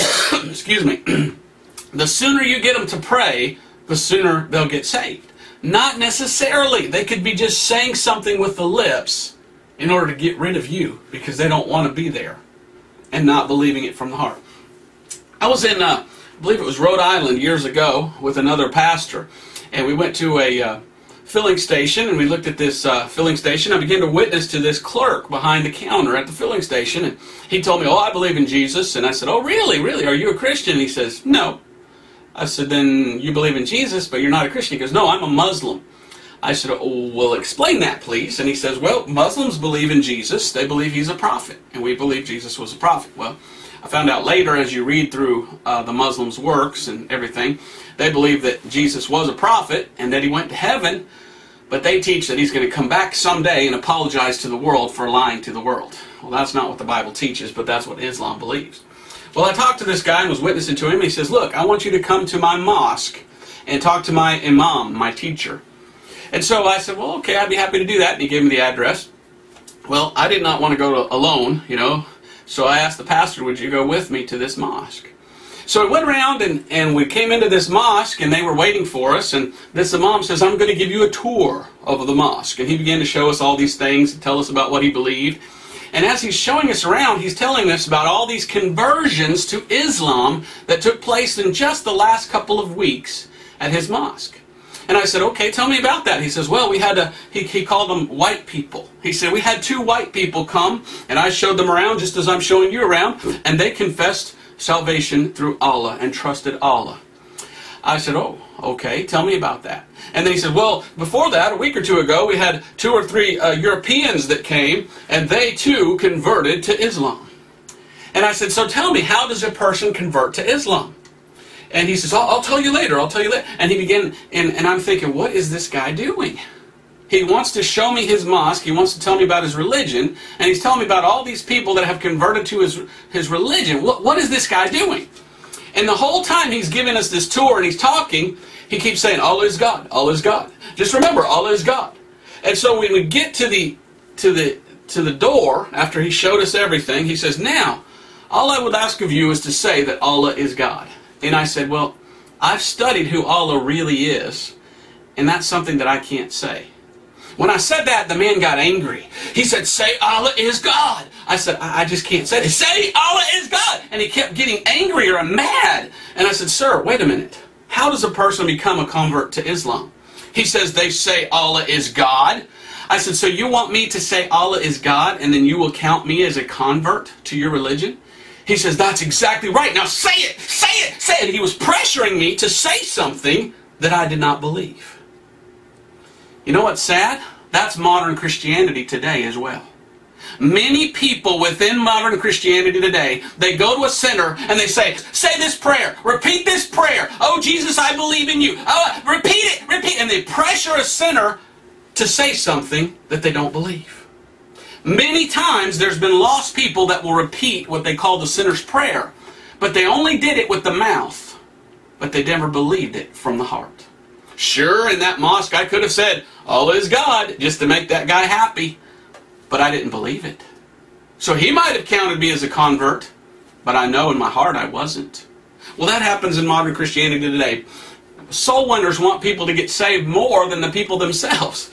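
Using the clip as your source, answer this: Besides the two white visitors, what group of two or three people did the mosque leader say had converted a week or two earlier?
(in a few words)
Europeans.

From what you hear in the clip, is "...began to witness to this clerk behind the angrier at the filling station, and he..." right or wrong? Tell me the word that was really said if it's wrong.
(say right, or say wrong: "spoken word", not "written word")
wrong: "counter", not "angrier".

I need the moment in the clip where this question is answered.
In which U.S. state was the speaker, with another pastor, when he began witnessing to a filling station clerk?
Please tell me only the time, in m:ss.
0:16.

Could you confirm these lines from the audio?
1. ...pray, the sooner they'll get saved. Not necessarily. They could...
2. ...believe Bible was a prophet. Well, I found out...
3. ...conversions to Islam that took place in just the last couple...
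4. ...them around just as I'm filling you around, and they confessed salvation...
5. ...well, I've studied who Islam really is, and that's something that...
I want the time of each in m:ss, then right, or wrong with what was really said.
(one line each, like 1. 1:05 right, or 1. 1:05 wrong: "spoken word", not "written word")
1. 0:03 right
2. 0:41 wrong: "Jesus", not "Bible"
3. 1:28 right
4. 1:41 wrong: "showing", not "filling"
5. 2:31 wrong: "Allah", not "Islam".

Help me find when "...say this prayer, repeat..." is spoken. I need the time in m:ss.
3:15.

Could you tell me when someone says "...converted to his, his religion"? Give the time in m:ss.
2:11.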